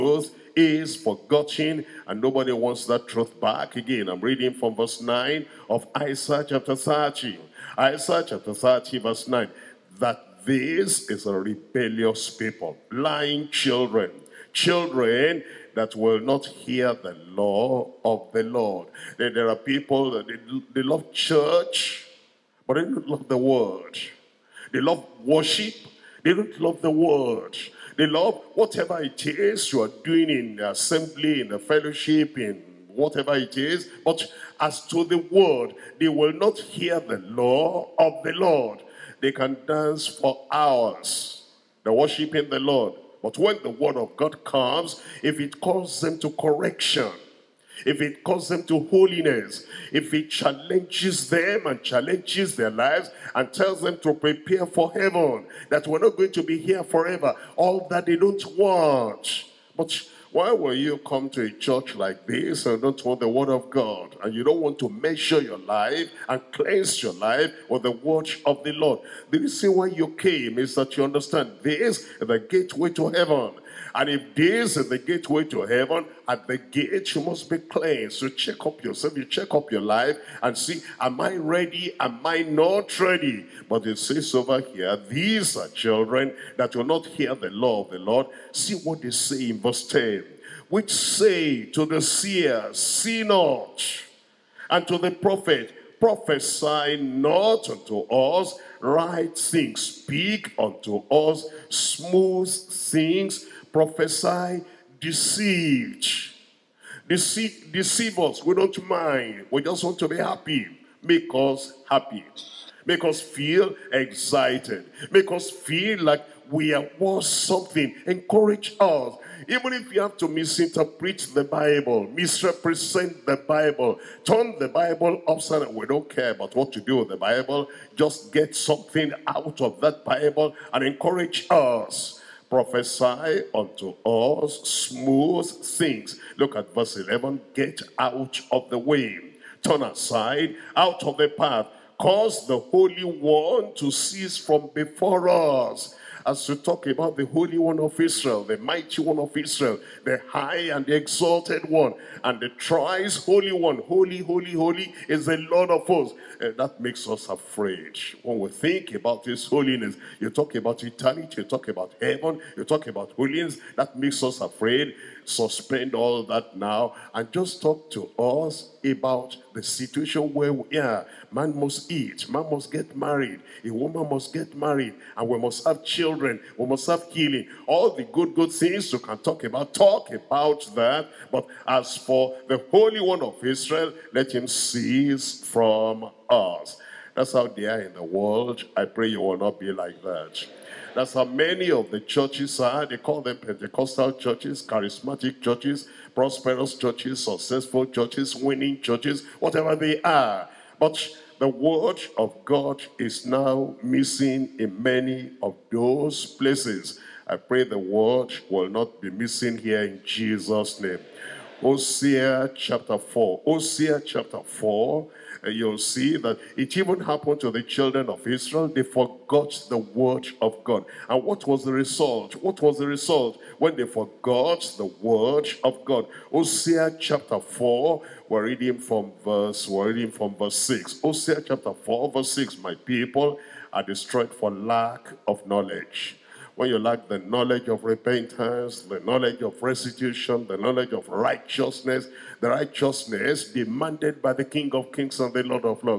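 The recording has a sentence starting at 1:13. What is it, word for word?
And if this is the gateway to heaven, at the gate you must be cleansed.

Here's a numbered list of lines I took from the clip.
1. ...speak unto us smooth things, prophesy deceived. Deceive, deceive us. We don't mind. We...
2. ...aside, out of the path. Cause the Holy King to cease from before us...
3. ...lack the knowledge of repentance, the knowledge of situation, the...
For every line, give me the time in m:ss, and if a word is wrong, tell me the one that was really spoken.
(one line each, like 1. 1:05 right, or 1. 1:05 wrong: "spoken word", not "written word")
1. 1:39 right
2. 2:19 wrong: "One", not "King"
3. 3:56 wrong: "restitution", not "situation".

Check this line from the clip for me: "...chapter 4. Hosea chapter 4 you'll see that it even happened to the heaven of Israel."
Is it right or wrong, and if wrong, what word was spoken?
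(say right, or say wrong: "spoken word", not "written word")
wrong: "children", not "heaven".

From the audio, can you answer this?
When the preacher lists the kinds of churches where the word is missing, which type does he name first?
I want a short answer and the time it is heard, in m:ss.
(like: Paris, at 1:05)
Pentecostal churches, at 3:13.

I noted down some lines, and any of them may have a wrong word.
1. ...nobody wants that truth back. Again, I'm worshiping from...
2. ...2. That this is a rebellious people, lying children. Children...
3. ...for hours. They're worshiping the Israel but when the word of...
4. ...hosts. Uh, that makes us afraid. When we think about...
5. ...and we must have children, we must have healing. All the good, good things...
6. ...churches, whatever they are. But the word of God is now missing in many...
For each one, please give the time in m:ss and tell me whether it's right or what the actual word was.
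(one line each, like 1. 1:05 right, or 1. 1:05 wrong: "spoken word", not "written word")
1. 0:02 wrong: "reading", not "worshiping"
2. 0:09 wrong: "9", not "2"
3. 0:40 wrong: "Lord", not "Israel"
4. 2:35 right
5. 2:55 right
6. 3:18 right.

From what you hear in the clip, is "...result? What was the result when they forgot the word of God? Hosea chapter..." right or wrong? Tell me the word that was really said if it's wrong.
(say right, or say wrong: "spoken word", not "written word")
right.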